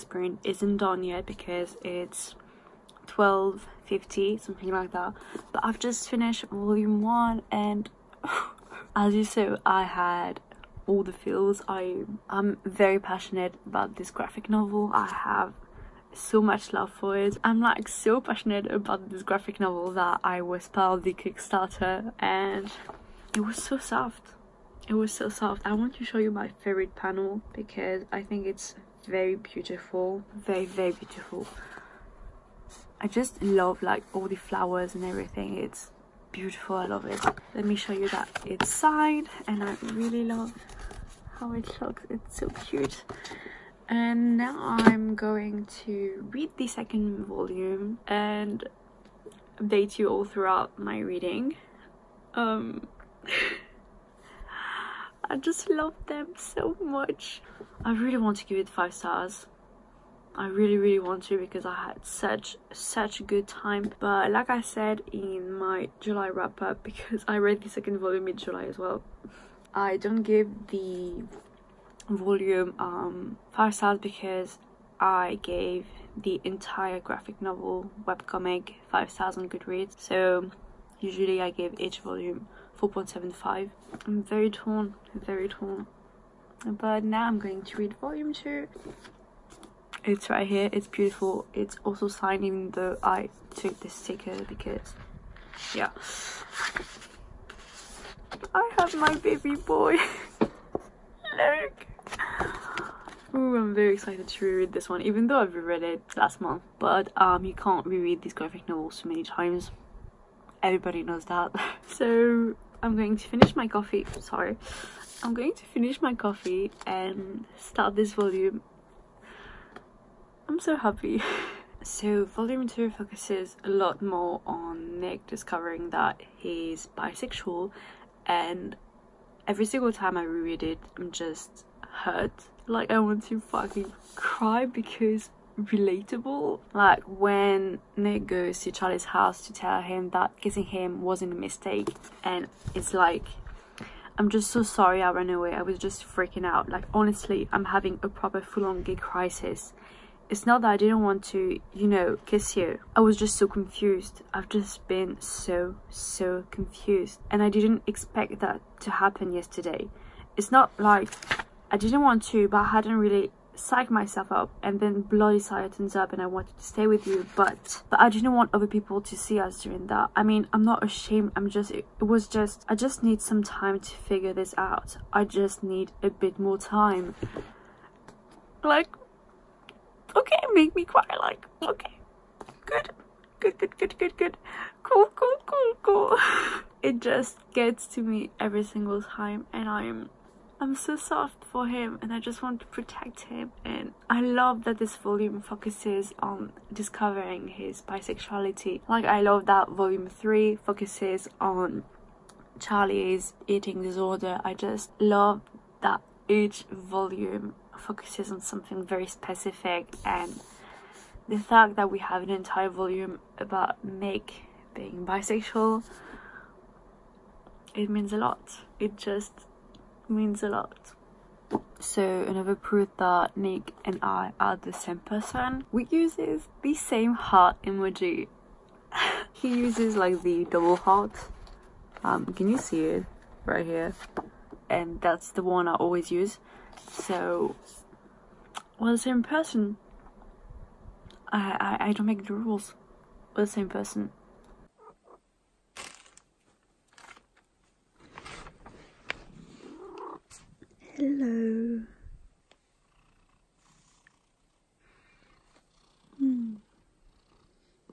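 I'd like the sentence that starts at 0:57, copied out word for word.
I really want to give it five stars.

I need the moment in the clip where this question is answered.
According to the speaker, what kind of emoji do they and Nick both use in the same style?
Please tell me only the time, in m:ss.
3:50.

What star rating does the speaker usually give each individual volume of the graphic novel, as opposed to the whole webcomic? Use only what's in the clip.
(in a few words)
4.75.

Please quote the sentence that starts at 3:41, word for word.
So another proof that Nick and I are the same person.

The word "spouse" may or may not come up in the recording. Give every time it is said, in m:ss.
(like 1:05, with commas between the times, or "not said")
not said.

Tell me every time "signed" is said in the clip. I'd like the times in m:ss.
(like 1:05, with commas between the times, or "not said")
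0:38, 1:32.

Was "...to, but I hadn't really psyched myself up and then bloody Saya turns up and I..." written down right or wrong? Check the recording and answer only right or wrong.
right.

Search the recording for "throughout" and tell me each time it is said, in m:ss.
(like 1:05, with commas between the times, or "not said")
0:50.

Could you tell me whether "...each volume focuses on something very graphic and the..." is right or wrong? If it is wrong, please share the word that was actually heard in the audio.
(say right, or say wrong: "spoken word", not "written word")
wrong: "specific", not "graphic".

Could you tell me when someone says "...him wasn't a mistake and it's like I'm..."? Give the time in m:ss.
2:20.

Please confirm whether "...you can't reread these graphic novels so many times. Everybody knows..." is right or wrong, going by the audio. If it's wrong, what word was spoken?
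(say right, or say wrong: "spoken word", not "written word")
right.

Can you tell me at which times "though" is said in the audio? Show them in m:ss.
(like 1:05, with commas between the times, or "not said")
1:32, 1:45.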